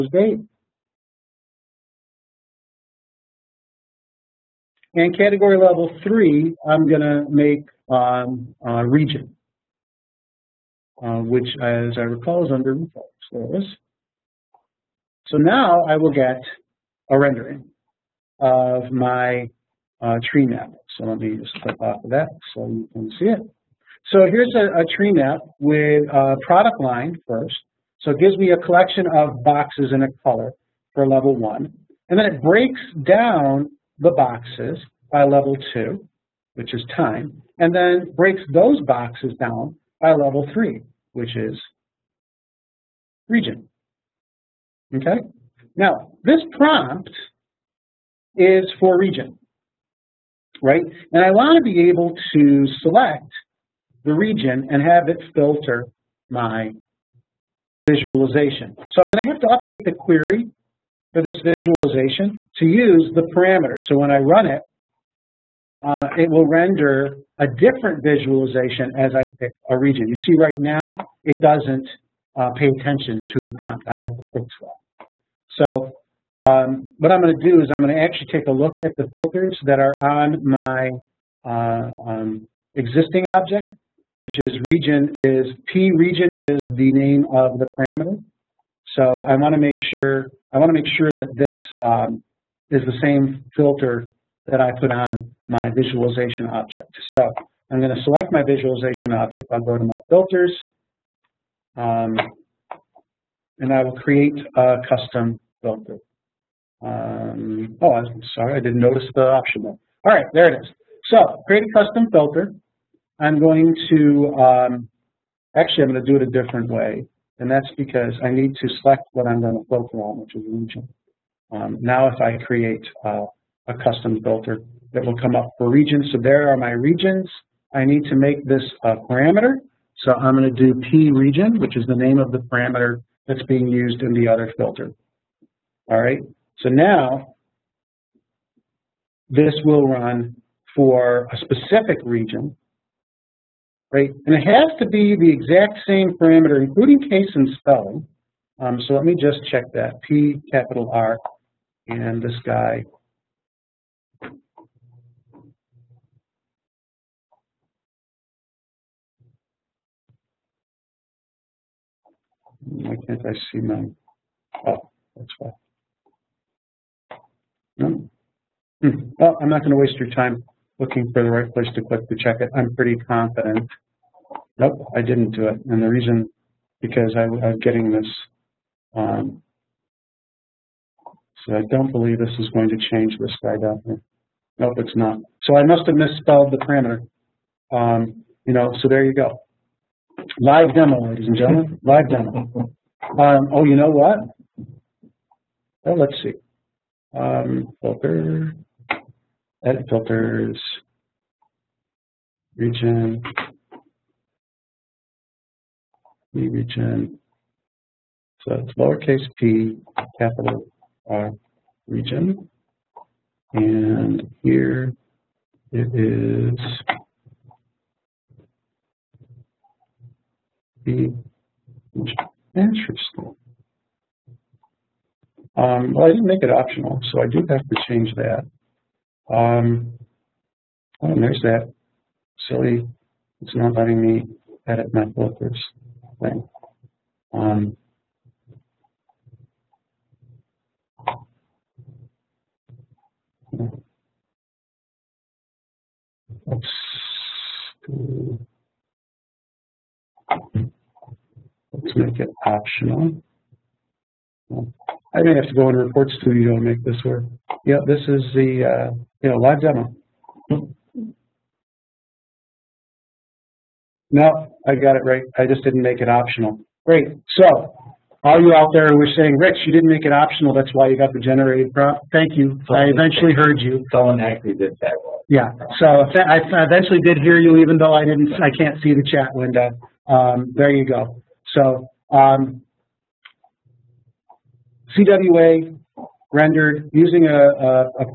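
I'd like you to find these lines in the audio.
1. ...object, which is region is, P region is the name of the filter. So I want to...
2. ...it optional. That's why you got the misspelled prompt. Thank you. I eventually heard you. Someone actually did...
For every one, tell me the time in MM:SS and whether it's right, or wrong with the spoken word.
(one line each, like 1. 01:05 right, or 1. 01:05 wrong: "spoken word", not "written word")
1. 01:23 wrong: "parameter", not "filter"
2. 04:30 wrong: "generated", not "misspelled".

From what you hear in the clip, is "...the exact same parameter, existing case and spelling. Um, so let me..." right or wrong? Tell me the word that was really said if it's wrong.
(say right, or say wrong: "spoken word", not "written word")
wrong: "including", not "existing".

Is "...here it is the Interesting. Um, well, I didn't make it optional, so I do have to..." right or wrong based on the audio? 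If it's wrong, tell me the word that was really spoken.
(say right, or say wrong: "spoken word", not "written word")
right.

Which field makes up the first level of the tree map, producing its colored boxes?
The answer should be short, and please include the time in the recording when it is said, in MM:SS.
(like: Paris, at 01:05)
Product line, at 00:26.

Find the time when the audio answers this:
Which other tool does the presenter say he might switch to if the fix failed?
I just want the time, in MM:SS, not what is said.
04:15.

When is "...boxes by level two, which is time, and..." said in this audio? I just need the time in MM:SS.
00:34.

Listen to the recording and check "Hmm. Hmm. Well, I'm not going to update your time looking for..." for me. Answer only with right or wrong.
wrong.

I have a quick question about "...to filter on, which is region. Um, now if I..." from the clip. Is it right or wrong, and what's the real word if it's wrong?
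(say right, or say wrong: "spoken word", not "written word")
right.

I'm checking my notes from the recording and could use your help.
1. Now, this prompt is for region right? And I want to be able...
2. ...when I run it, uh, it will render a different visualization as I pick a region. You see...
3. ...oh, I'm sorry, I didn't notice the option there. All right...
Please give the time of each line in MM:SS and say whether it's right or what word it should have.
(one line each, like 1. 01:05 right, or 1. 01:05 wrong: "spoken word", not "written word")
1. 00:45 right
2. 01:03 right
3. 01:47 right.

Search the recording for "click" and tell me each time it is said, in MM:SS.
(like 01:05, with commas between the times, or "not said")
00:21, 02:51.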